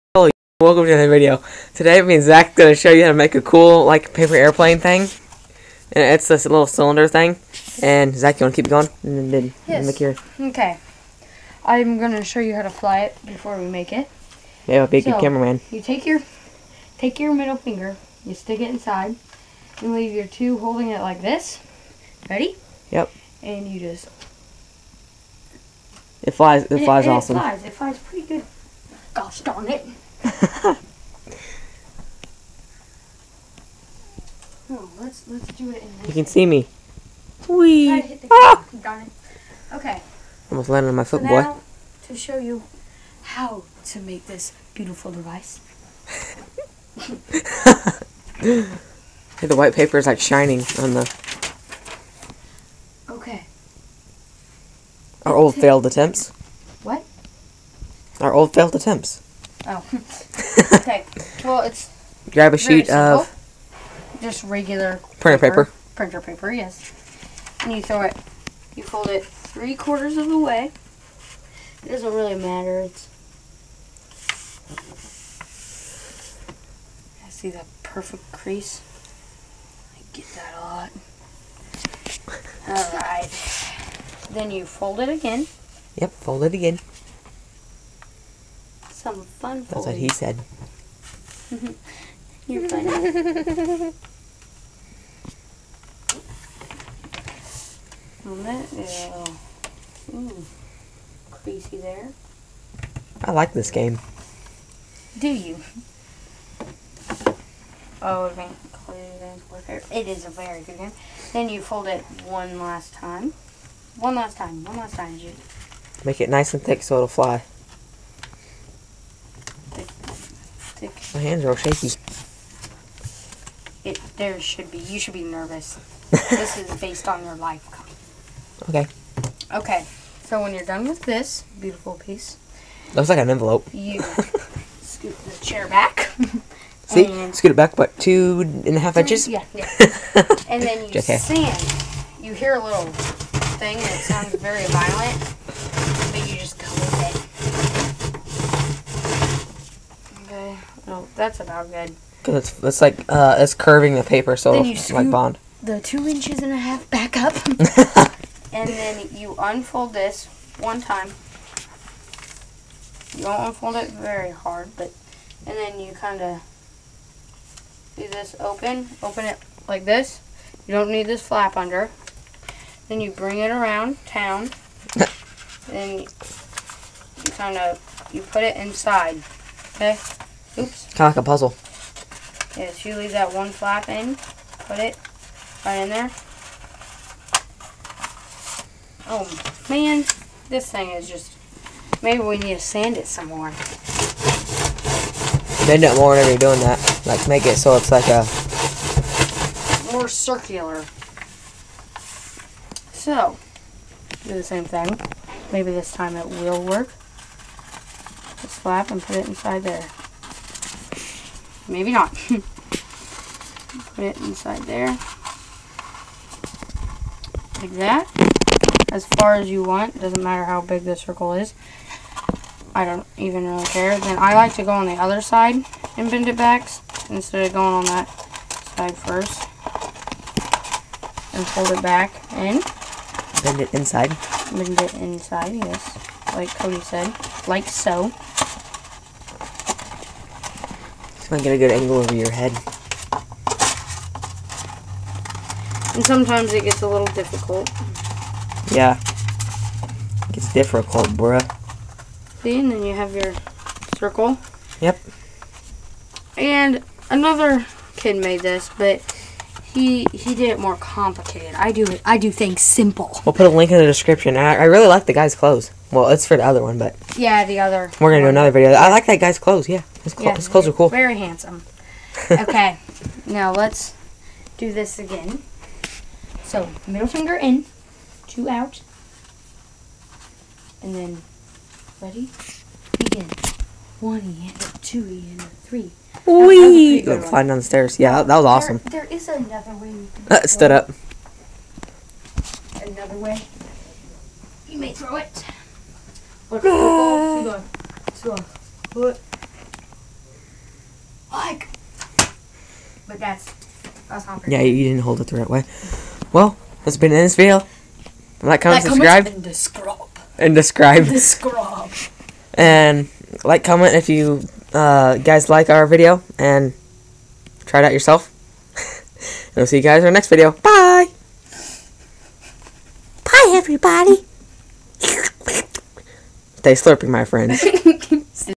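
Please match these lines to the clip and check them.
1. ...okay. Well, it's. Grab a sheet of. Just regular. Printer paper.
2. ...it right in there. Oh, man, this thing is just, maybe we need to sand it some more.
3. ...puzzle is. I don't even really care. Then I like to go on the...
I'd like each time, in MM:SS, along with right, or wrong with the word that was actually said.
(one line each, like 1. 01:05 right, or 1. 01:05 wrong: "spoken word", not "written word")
1. 01:00 right
2. 03:04 right
3. 03:40 wrong: "circle", not "puzzle".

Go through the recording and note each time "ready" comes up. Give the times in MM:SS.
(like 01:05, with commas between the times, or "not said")
00:22, 04:42.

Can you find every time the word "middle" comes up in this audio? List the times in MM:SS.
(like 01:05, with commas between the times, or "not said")
00:17, 04:36.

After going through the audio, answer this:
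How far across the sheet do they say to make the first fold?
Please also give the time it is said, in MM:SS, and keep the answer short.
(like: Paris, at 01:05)
Three quarters, at 01:09.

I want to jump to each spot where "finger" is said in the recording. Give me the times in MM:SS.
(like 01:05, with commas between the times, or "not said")
00:17, 04:37.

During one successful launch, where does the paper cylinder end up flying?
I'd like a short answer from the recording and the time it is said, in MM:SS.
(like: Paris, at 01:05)
Down the stairs, at 04:47.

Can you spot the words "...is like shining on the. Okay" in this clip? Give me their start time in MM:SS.
00:49.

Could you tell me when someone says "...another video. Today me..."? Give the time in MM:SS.
00:00.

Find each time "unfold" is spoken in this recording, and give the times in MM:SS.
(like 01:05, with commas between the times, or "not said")
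02:39, 02:43.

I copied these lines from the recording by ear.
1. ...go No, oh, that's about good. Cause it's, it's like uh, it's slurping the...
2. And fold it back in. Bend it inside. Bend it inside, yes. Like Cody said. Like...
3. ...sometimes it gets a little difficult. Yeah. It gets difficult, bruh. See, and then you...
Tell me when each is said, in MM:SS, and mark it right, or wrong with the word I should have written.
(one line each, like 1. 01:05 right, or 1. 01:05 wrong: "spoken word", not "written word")
1. 02:26 wrong: "curving", not "slurping"
2. 03:51 right
3. 04:06 right.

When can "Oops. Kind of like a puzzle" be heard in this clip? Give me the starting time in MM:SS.
03:00.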